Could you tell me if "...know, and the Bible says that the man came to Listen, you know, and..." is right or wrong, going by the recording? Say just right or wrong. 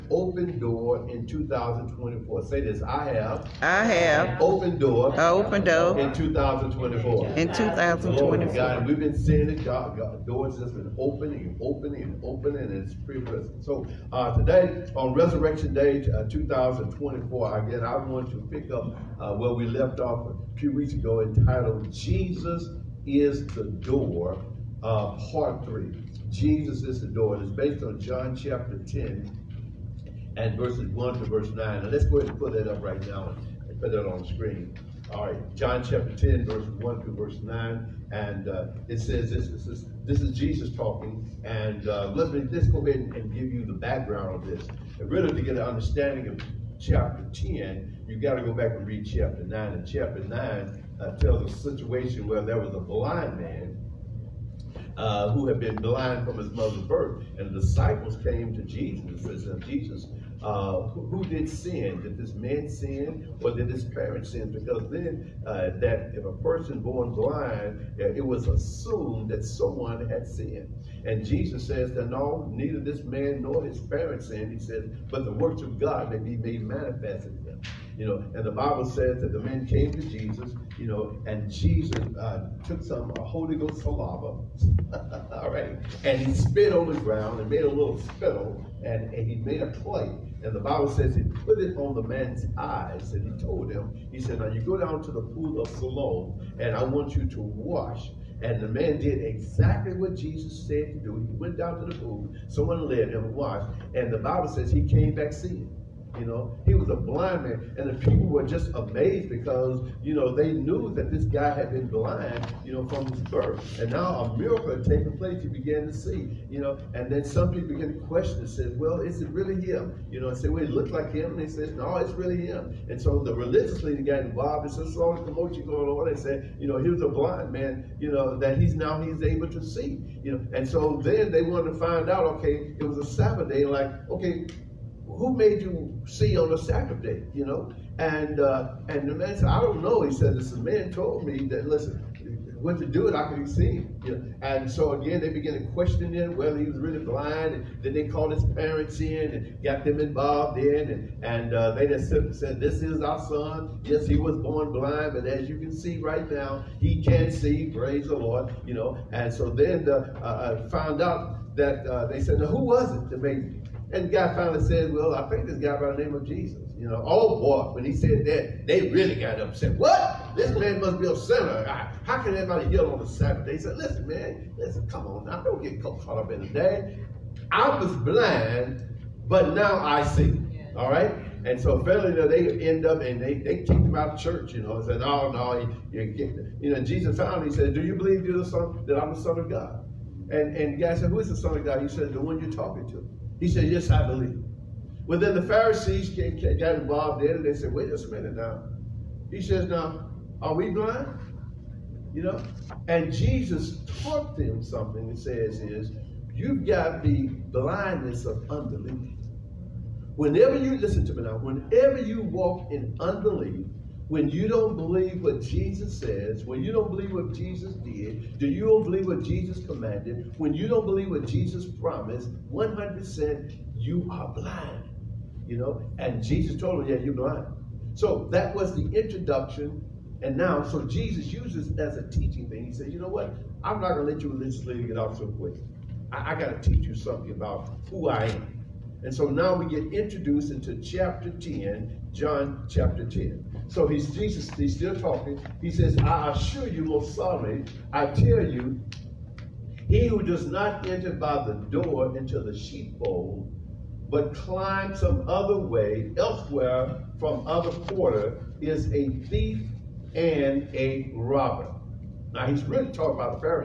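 wrong.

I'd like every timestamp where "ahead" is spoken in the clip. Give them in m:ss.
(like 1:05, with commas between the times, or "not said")
0:32, 0:42.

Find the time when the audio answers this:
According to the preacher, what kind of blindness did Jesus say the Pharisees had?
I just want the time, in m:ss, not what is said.
3:27.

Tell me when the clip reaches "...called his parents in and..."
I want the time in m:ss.
2:28.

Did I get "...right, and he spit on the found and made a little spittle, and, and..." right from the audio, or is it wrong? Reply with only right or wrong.
wrong.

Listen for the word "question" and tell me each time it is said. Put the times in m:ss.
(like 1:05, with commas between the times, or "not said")
1:58, 2:25.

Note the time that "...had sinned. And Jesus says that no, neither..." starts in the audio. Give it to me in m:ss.
1:10.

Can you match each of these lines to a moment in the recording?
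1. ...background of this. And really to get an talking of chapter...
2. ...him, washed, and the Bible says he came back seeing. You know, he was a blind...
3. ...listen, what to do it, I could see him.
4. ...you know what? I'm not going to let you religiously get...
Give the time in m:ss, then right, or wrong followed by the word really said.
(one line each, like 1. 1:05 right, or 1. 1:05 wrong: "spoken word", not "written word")
1. 0:43 wrong: "understanding", not "talking"
2. 1:43 right
3. 2:21 right
4. 3:52 right.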